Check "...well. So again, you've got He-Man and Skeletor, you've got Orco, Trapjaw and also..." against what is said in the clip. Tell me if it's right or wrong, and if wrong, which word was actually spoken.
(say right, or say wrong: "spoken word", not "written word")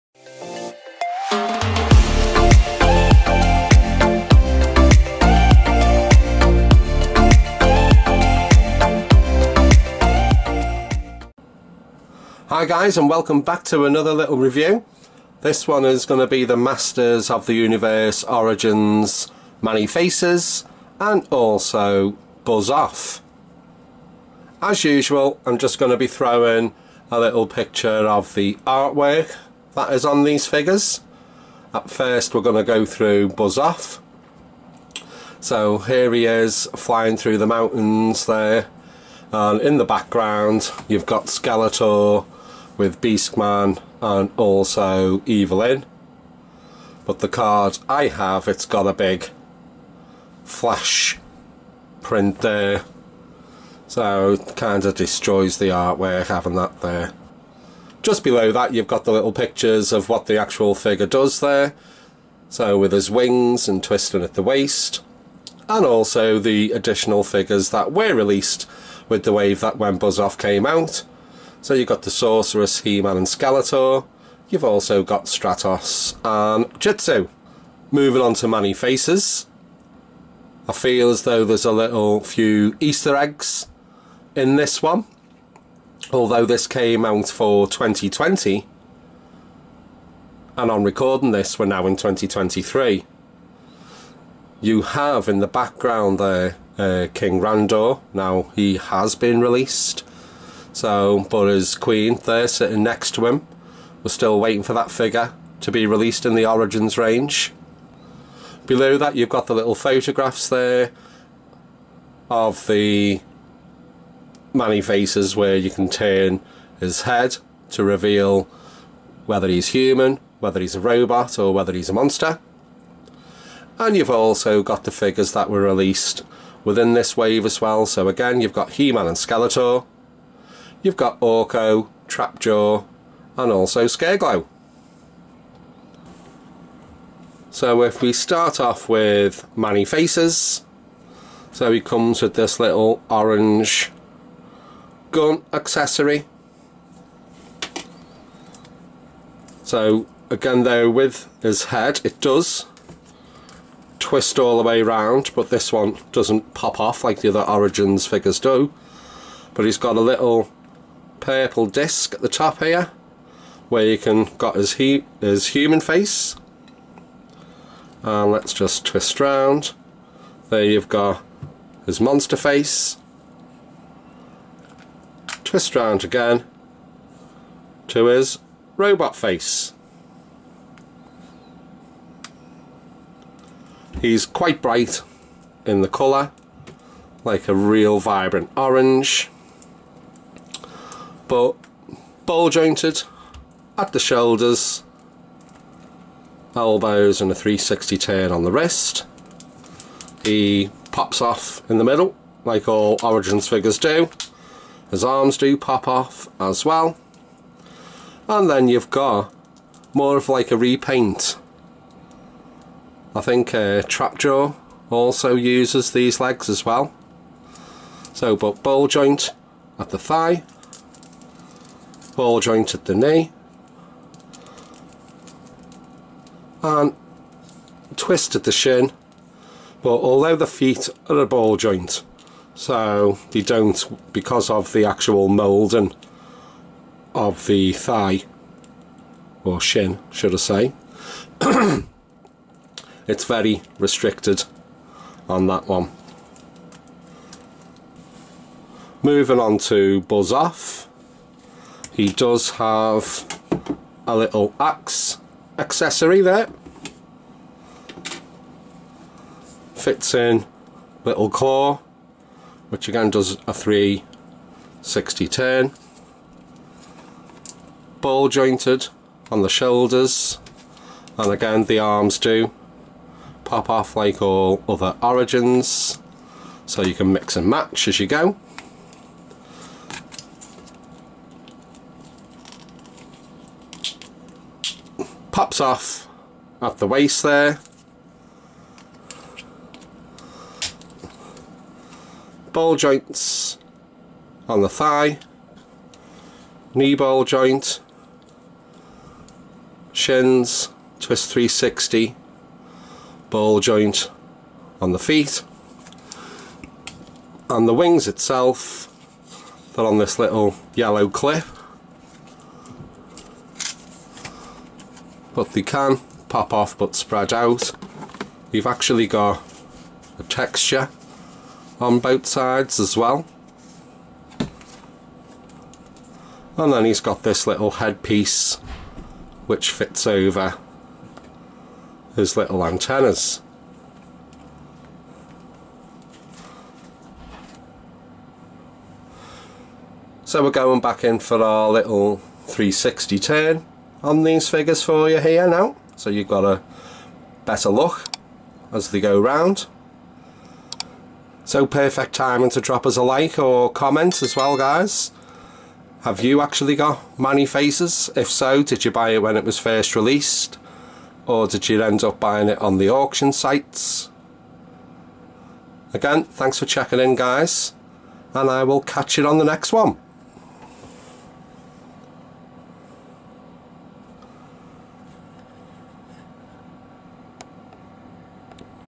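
right.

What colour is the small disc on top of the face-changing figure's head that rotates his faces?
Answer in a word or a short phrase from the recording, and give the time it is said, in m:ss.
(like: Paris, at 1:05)
Purple, at 2:41.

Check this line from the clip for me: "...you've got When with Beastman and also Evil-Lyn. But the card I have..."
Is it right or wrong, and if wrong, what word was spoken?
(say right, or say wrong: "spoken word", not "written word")
wrong: "Skeletor", not "When".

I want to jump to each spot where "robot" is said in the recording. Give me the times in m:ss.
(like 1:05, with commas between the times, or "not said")
2:00, 2:58.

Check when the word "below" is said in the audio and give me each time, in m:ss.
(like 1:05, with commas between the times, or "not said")
0:58, 1:48.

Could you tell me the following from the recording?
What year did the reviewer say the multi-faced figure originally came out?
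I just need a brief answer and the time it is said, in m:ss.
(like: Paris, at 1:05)
2020, at 1:27.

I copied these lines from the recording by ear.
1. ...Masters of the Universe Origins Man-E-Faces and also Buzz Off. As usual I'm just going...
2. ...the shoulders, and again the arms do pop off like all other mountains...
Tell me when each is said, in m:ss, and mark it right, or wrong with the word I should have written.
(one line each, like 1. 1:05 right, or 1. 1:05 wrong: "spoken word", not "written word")
1. 0:16 right
2. 4:29 wrong: "origins", not "mountains".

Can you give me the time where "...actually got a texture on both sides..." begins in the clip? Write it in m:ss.
5:18.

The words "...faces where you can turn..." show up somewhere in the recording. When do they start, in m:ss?
1:54.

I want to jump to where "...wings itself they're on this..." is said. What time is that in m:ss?
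5:07.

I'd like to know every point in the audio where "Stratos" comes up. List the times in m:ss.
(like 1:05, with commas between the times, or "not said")
1:15.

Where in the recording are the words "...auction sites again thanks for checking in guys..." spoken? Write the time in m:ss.
6:02.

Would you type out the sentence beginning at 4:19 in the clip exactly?
Fits in little claw, which again does a 360 turn.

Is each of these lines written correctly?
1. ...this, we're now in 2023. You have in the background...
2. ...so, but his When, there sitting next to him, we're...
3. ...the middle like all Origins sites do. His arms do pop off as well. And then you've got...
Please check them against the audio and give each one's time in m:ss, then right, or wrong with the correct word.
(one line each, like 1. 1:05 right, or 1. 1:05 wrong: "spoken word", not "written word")
1. 1:31 right
2. 1:40 wrong: "Queen", not "When"
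3. 3:21 wrong: "figures", not "sites".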